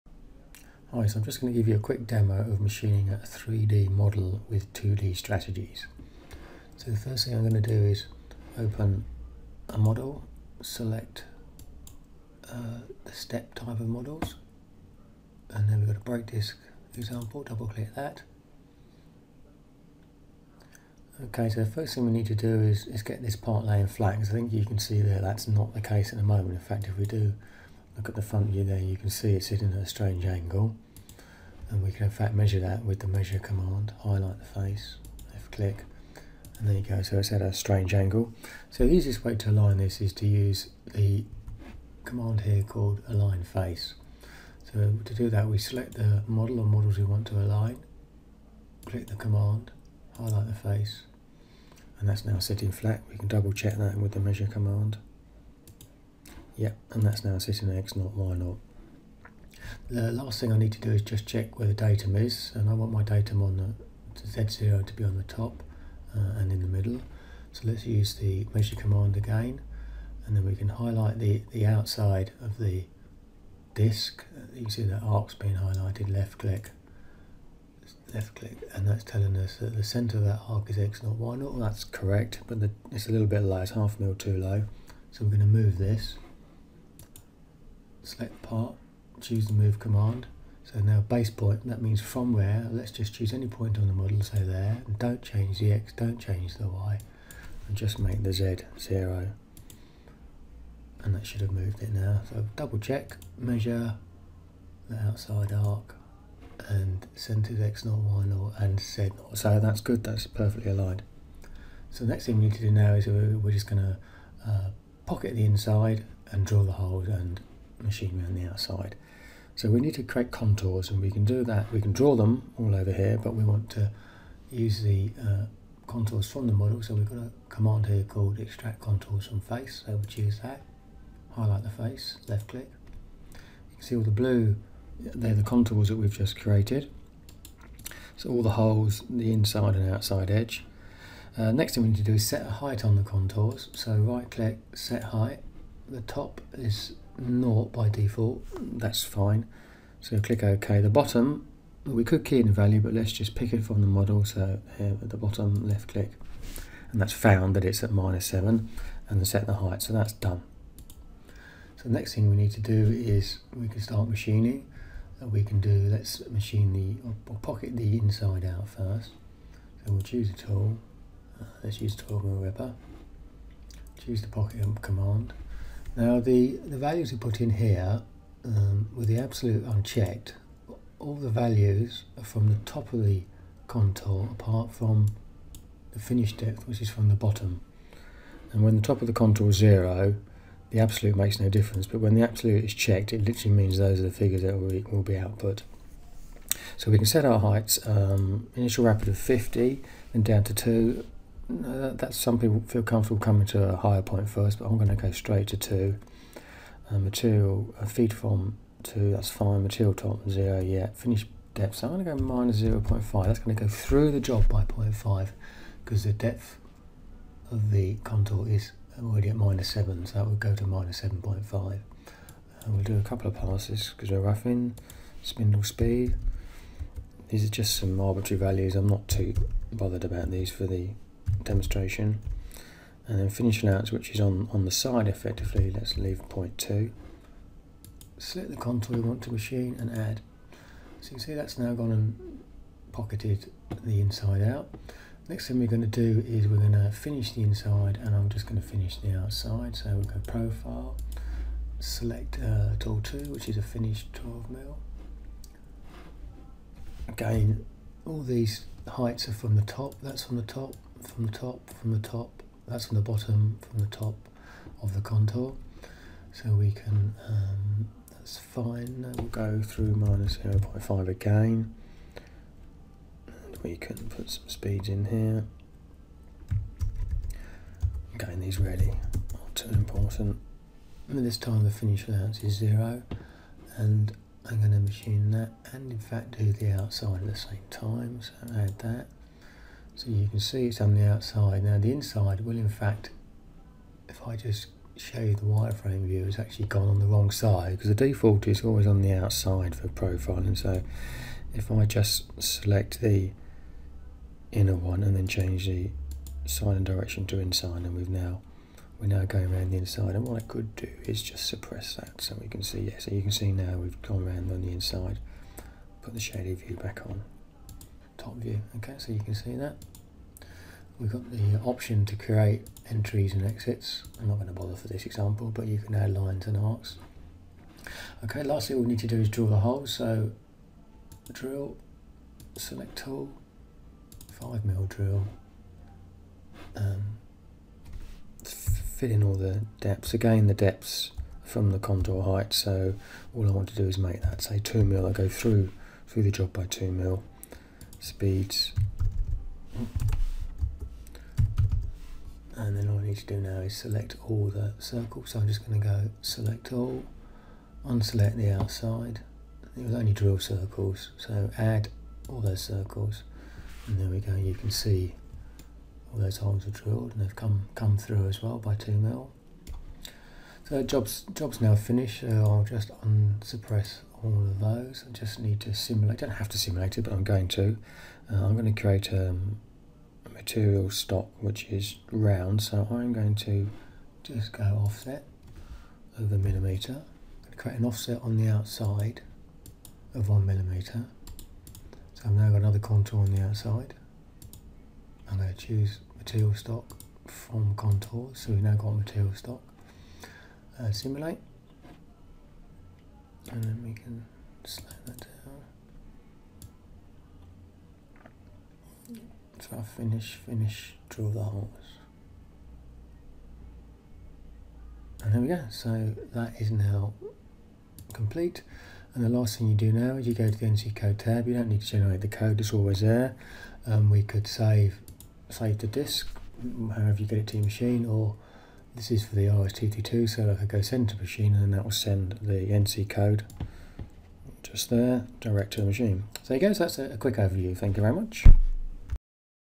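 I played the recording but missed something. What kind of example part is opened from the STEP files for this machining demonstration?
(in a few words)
Brake disc.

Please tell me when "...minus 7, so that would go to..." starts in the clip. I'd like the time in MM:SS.
03:39.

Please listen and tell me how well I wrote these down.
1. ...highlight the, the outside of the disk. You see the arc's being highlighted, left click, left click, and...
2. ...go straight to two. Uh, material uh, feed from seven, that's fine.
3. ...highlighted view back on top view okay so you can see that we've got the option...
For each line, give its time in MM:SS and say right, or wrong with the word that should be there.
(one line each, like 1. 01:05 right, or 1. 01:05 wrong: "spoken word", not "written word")
1. 01:10 right
2. 03:24 wrong: "two", not "seven"
3. 05:16 wrong: "shaded", not "highlighted".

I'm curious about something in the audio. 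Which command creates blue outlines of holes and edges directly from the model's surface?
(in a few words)
Extract contours from face.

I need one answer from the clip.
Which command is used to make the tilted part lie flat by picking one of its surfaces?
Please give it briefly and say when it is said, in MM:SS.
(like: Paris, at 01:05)
Align face, at 00:43.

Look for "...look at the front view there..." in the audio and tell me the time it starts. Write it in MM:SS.
00:27.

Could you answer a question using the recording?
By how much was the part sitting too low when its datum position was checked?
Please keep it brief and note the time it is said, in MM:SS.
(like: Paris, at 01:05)
Half mil, at 01:23.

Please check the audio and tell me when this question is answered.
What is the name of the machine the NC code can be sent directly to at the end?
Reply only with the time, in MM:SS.
07:09.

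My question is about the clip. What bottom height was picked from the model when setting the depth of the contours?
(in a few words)
-7.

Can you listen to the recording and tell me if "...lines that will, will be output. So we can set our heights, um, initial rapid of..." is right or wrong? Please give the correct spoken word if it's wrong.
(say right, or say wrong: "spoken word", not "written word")
wrong: "figures", not "lines".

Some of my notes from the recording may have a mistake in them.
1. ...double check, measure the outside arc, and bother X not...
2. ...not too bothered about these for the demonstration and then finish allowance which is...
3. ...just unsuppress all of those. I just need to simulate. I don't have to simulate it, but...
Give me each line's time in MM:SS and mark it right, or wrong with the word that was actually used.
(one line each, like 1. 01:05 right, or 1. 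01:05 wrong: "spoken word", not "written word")
1. 01:42 wrong: "center", not "bother"
2. 03:48 right
3. 06:12 right.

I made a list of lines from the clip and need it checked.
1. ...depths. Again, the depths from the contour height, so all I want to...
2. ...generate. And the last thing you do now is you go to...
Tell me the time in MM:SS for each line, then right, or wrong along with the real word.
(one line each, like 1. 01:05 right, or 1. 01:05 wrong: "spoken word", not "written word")
1. 05:39 right
2. 06:58 wrong: "complete", not "generate".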